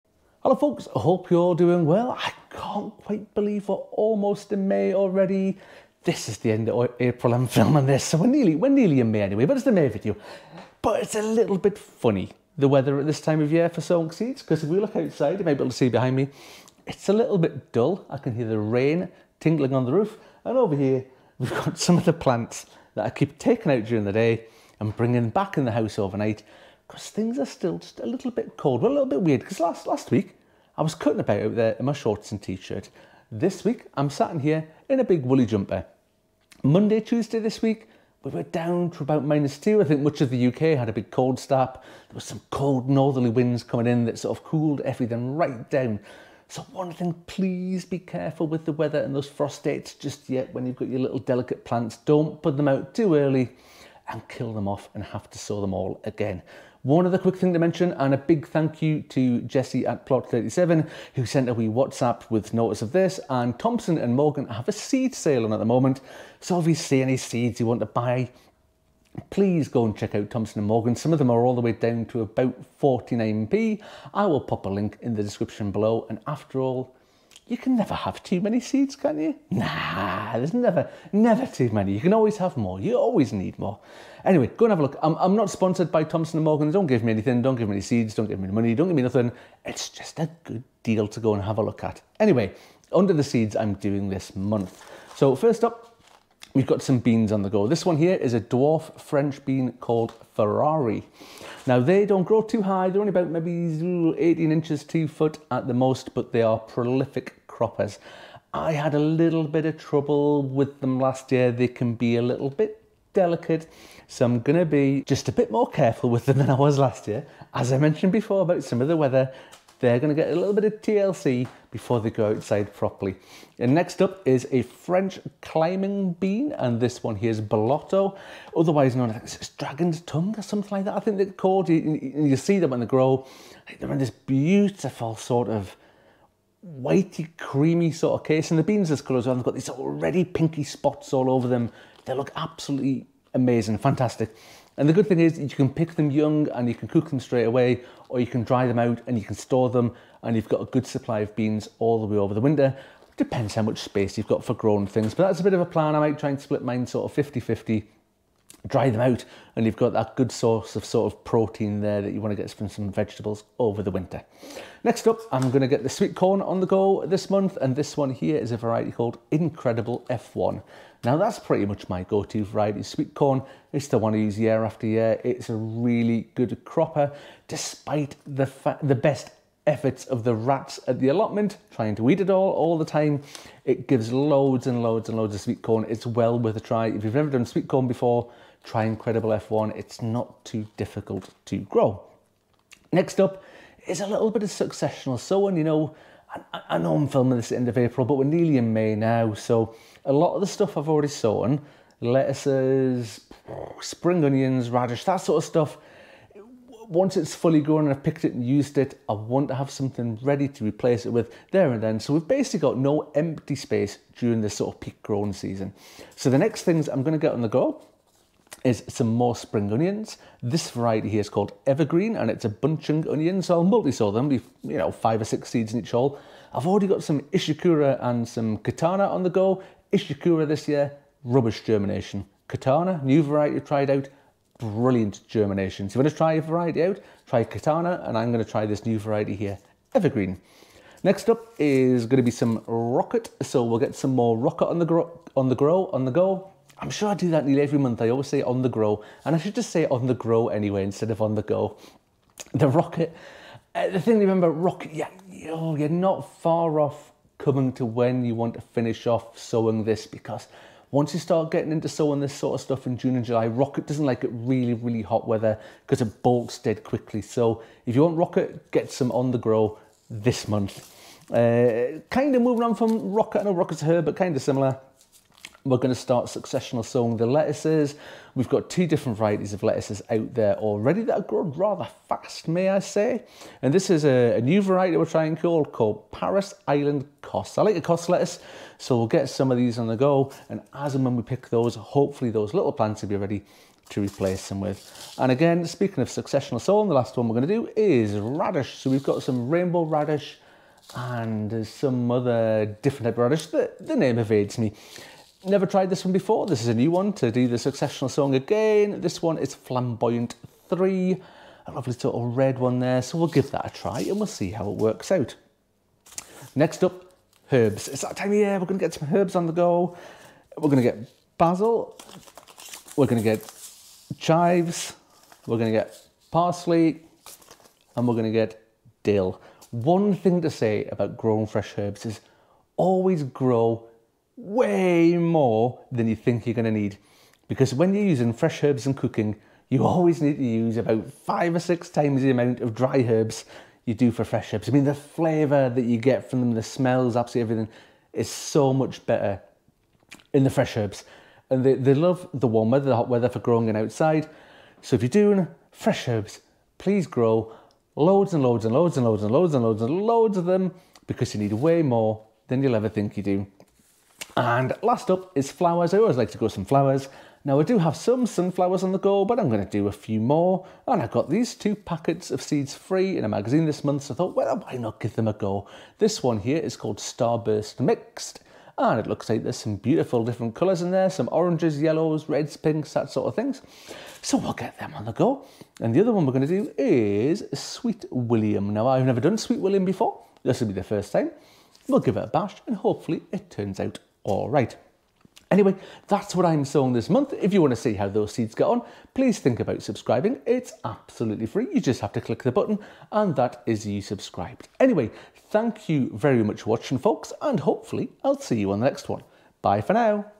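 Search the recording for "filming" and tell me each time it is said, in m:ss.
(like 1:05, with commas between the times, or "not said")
0:07, 3:17.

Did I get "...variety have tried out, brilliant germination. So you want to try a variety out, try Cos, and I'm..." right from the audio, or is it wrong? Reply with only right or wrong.
wrong.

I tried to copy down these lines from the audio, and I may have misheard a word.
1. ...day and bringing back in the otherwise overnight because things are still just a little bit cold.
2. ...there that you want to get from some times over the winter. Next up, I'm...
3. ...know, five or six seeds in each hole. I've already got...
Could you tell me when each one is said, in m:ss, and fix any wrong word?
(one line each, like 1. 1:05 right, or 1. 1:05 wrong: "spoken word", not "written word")
1. 0:24 wrong: "house", not "otherwise"
2. 2:41 wrong: "vegetables", not "times"
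3. 3:44 right.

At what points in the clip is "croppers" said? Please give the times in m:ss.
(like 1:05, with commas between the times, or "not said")
1:47, 2:56.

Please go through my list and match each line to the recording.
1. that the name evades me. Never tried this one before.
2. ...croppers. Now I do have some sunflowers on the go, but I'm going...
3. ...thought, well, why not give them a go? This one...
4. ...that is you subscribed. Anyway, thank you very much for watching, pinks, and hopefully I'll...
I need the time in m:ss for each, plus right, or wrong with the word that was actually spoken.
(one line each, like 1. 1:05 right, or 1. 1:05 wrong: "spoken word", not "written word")
1. 5:03 right
2. 6:06 wrong: "flowers", not "croppers"
3. 6:14 right
4. 6:43 wrong: "folks", not "pinks".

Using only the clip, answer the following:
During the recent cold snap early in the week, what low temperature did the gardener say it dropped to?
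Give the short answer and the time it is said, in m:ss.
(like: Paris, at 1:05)
-2, at 0:39.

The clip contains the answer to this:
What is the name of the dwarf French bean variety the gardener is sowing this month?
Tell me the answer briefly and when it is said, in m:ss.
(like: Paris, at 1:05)
Ferrari, at 1:40.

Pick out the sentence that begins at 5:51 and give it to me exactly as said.
And they, they love the warm weather, the hot weather for growing in outside.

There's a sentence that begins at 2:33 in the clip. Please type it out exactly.
Depends how much space you've got for growing things, but that's a bit of a plan.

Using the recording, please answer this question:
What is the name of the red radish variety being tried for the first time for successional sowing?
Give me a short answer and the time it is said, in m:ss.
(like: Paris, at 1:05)
Flamboyant 3, at 5:09.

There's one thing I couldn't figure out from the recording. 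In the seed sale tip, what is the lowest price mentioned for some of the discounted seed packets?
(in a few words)
49p.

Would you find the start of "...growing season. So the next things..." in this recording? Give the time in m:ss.
3:35.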